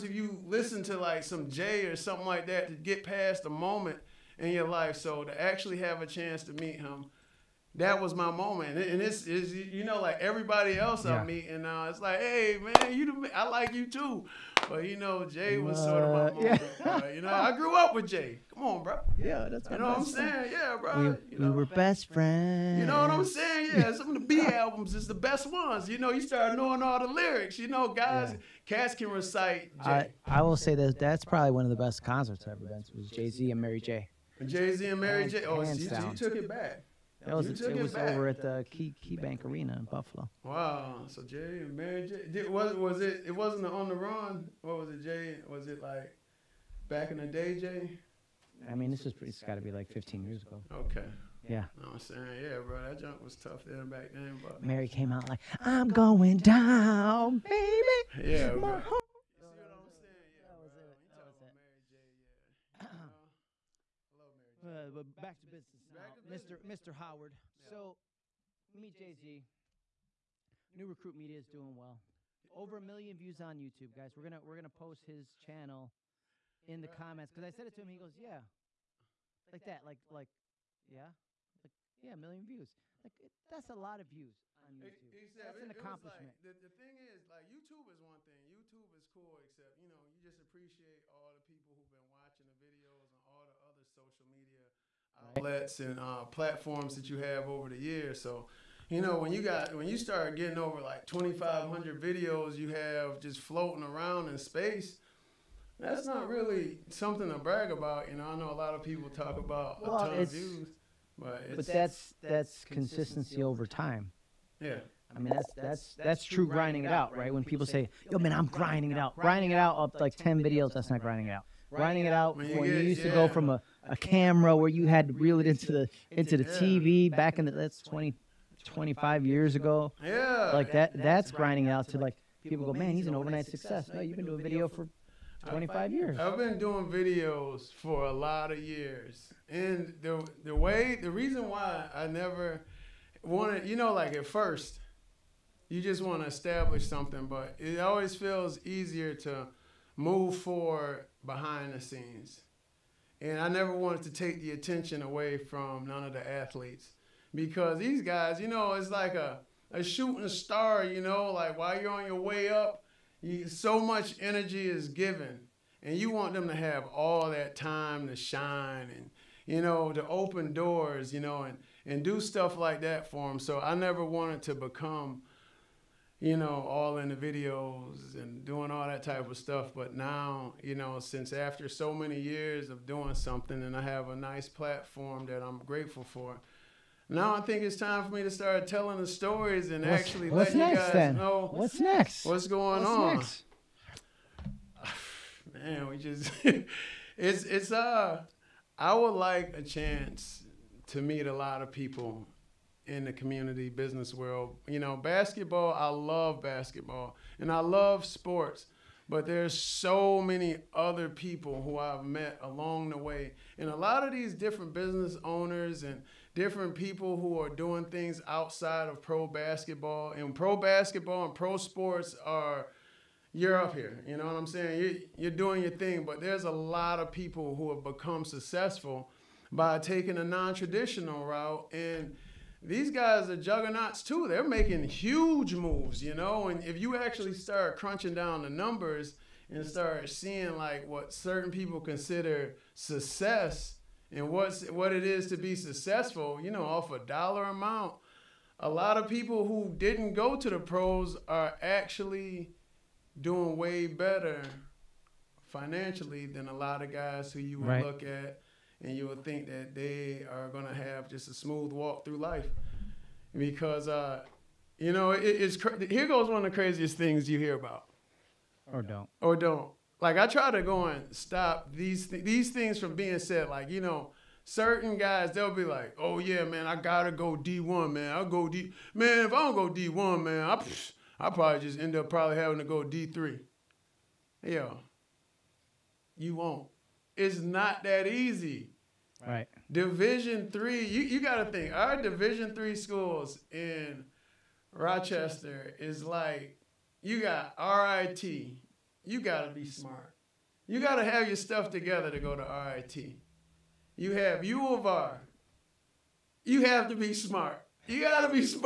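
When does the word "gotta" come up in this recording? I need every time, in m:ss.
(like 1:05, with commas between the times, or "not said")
4:36, 4:51.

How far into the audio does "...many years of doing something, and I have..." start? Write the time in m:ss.
3:01.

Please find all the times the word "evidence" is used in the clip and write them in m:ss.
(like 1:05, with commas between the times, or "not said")
not said.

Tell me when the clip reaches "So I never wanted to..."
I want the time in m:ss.
2:53.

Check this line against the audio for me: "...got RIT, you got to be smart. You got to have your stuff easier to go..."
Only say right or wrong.
wrong.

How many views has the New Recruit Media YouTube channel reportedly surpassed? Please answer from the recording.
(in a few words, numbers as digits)
over a million.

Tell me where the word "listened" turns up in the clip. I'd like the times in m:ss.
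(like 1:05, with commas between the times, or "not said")
0:00.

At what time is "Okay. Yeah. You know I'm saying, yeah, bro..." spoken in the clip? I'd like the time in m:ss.
0:50.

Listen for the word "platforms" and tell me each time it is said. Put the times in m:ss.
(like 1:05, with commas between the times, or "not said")
1:36, 3:04.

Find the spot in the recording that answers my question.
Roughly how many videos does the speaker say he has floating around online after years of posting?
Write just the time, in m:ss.
1:41.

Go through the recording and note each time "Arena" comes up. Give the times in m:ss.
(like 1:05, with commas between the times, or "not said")
0:39.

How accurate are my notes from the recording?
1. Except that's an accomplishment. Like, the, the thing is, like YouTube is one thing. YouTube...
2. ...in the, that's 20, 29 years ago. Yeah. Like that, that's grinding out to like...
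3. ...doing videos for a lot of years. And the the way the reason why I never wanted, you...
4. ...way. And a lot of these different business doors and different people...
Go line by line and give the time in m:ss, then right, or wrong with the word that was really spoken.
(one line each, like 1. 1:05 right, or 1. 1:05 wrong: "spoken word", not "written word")
1. 1:25 right
2. 2:07 wrong: "25", not "29"
3. 2:16 right
4. 3:32 wrong: "owners", not "doors".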